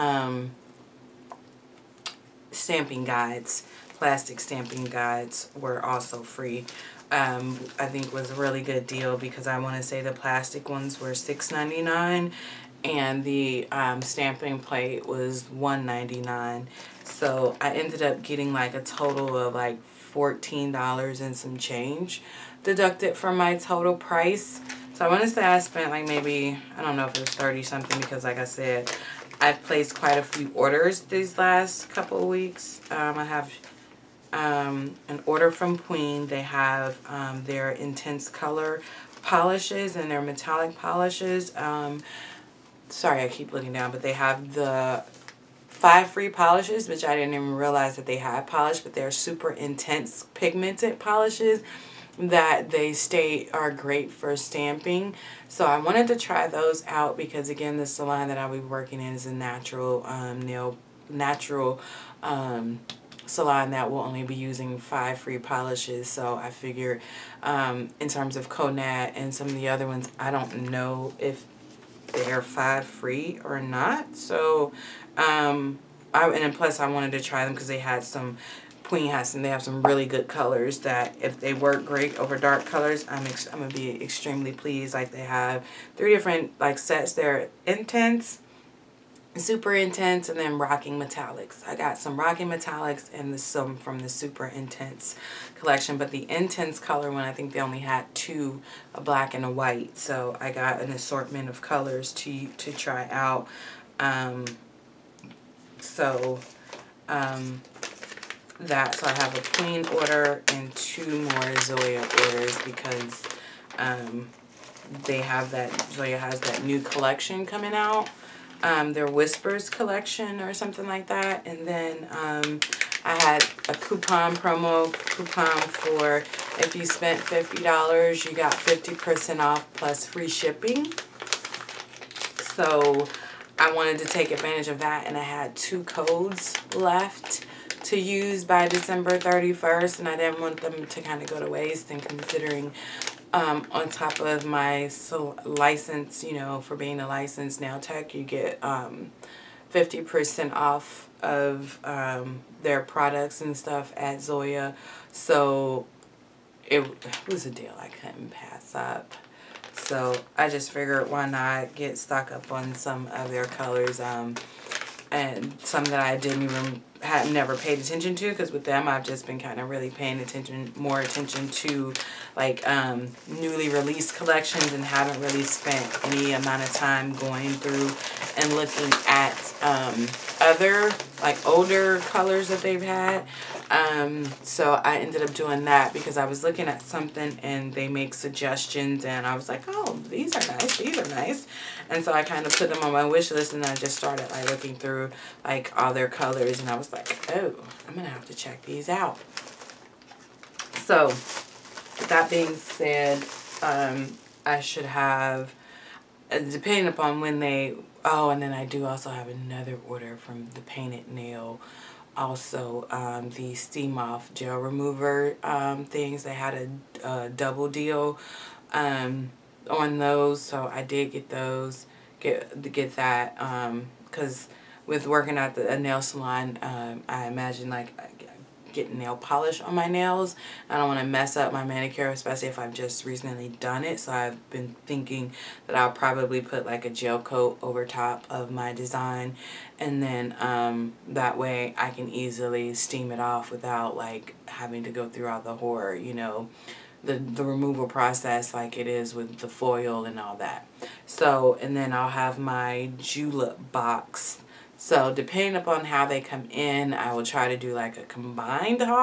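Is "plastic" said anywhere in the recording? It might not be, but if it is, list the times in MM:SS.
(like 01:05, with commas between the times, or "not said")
00:03, 00:10.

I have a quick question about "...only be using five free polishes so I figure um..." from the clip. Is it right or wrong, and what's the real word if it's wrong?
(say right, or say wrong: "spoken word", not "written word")
right.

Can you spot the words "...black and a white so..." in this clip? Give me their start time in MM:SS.
01:38.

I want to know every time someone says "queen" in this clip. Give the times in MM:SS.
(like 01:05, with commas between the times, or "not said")
00:35, 01:18, 01:49.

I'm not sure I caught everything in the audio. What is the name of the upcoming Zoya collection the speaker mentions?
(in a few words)
Whispers.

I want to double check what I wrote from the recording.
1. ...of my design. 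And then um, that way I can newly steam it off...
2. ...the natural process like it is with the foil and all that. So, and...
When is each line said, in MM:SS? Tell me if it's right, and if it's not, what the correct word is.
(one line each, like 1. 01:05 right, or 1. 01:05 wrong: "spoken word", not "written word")
1. 03:58 wrong: "easily", not "newly"
2. 04:07 wrong: "removal", not "natural".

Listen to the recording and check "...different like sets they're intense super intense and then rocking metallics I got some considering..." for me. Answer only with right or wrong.
wrong.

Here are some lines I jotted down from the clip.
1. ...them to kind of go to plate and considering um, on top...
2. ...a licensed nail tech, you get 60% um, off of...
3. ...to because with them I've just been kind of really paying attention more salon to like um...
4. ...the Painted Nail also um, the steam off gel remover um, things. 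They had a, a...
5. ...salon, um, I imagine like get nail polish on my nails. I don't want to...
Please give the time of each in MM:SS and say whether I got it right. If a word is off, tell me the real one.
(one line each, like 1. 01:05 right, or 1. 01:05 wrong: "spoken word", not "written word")
1. 02:20 wrong: "waste", not "plate"
2. 02:26 wrong: "50", not "60"
3. 02:48 wrong: "attention", not "salon"
4. 03:30 right
5. 03:46 right.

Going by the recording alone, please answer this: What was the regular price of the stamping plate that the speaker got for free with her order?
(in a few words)
$1.99.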